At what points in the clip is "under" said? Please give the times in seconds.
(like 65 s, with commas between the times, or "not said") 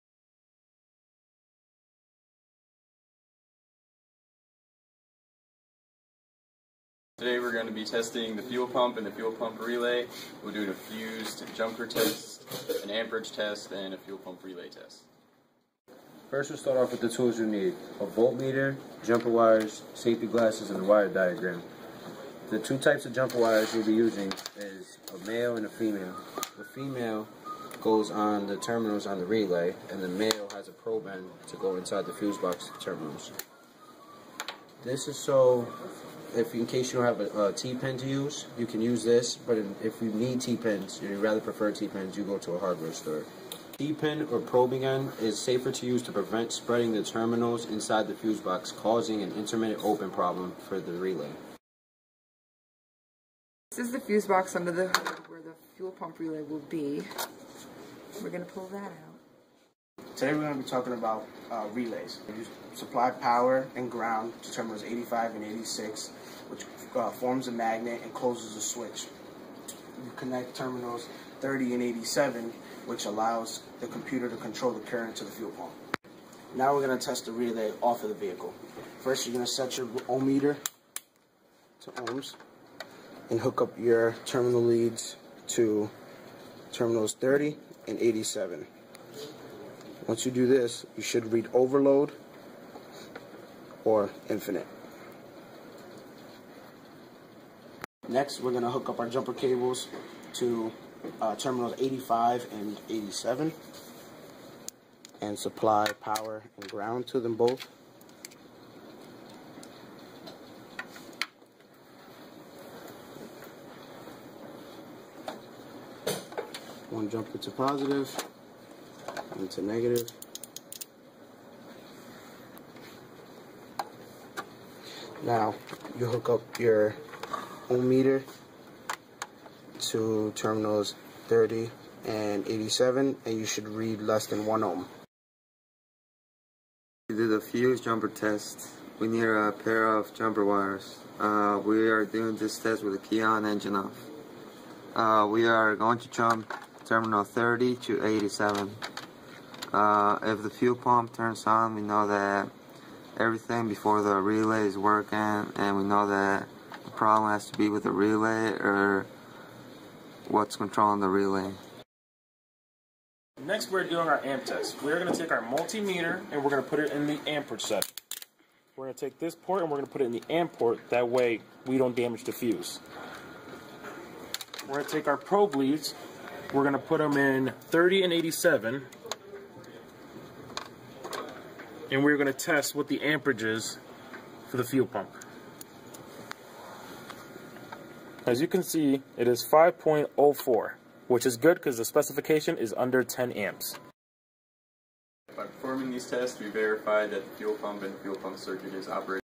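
54 s, 192 s.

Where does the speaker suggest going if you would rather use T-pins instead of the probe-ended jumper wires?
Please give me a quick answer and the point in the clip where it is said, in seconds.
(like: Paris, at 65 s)
hardware store, at 42 s.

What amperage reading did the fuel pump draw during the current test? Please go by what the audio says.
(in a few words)
5.04.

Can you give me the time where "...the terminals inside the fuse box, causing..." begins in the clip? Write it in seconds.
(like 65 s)
46 s.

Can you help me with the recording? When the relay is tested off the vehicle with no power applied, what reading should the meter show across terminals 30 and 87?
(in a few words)
overload or infinite.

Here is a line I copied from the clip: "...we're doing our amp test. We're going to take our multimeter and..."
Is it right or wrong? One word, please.
right.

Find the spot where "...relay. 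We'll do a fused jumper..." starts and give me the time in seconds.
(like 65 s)
9 s.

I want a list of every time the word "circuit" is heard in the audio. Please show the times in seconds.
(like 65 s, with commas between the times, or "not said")
198 s.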